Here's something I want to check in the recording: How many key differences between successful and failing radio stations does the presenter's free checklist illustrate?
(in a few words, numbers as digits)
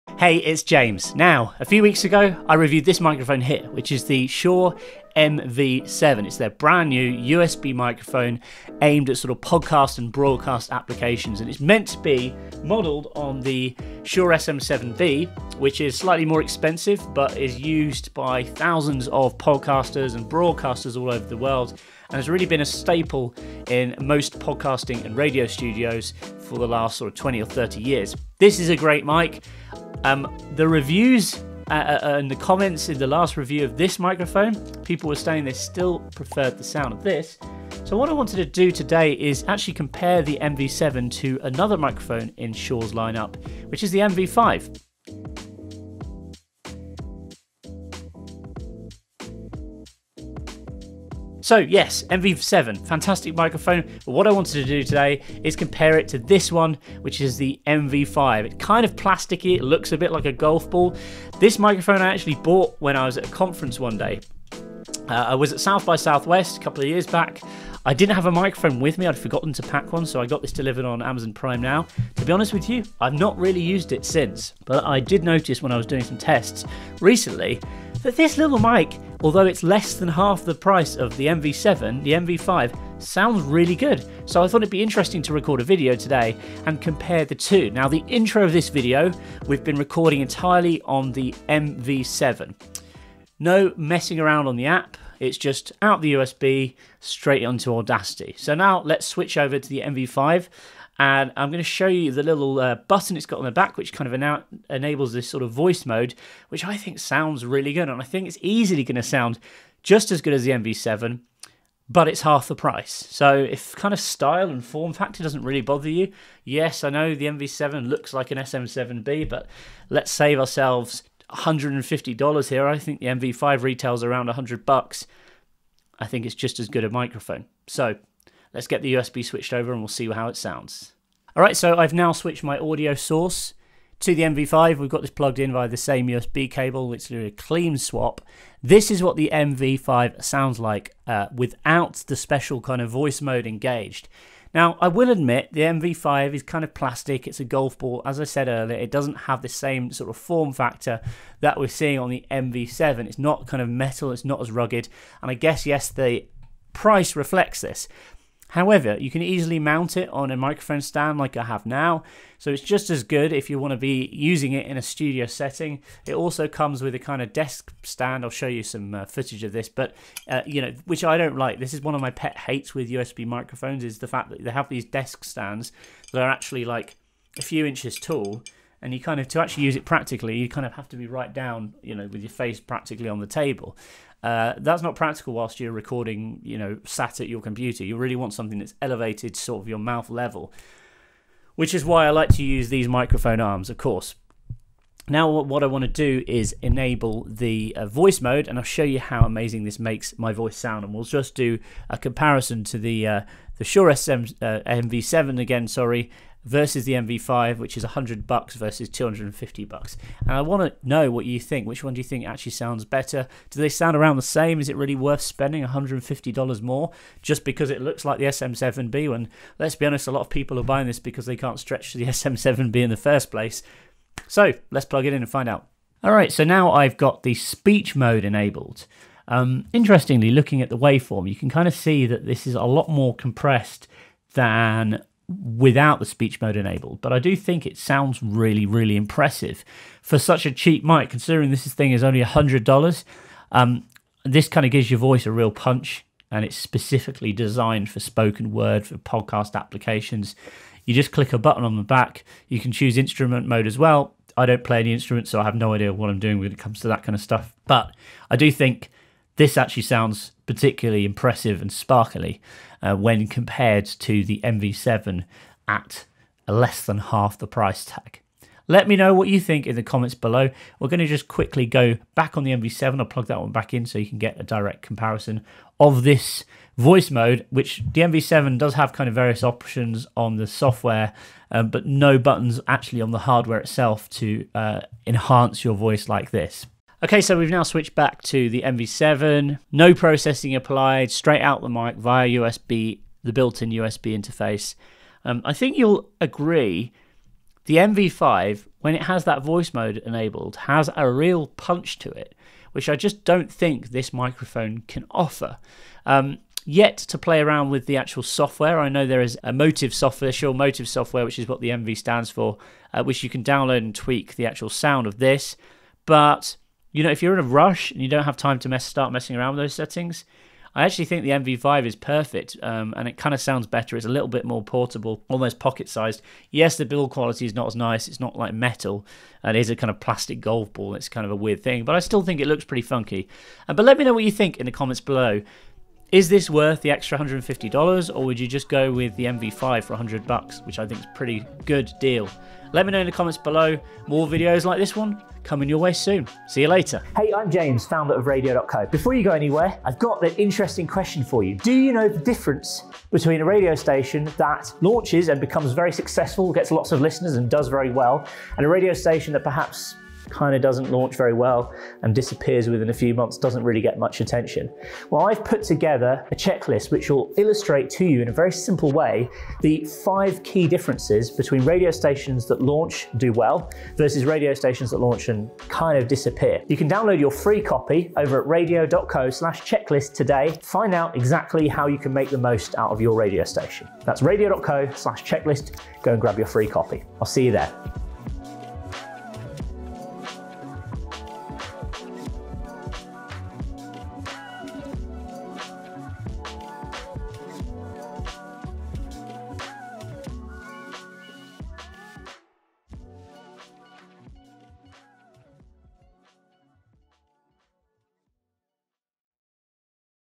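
5.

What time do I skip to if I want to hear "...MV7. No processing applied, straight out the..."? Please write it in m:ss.
4:48.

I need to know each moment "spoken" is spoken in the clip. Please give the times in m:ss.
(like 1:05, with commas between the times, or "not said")
4:07.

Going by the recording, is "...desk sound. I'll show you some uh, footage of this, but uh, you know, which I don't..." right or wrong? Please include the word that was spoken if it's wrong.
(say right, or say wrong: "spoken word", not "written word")
wrong: "stand", not "sound".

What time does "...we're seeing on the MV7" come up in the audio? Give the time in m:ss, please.
2:31.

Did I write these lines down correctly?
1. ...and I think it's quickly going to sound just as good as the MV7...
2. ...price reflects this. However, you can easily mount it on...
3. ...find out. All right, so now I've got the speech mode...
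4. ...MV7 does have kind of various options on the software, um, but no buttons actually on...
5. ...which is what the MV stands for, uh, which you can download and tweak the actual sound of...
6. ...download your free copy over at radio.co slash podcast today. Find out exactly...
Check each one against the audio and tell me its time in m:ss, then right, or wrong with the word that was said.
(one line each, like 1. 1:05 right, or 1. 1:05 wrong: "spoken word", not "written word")
1. 1:47 wrong: "easily", not "quickly"
2. 2:36 right
3. 3:45 right
4. 4:38 right
5. 5:11 right
6. 6:16 wrong: "checklist", not "podcast".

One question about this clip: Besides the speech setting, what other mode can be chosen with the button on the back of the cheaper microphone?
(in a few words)
instrument mode.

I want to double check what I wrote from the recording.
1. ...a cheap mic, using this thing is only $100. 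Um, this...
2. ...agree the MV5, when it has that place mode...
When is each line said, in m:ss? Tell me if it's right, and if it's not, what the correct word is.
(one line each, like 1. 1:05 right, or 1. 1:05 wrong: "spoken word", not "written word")
1. 4:00 wrong: "considering", not "using"
2. 4:56 wrong: "voice", not "place".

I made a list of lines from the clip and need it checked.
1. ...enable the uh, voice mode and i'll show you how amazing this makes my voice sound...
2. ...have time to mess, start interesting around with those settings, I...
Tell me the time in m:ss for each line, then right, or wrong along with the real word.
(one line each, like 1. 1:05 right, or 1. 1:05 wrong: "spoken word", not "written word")
1. 3:16 right
2. 5:18 wrong: "messing", not "interesting".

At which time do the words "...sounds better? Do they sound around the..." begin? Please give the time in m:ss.
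3:32.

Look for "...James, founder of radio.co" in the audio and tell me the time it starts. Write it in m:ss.
5:47.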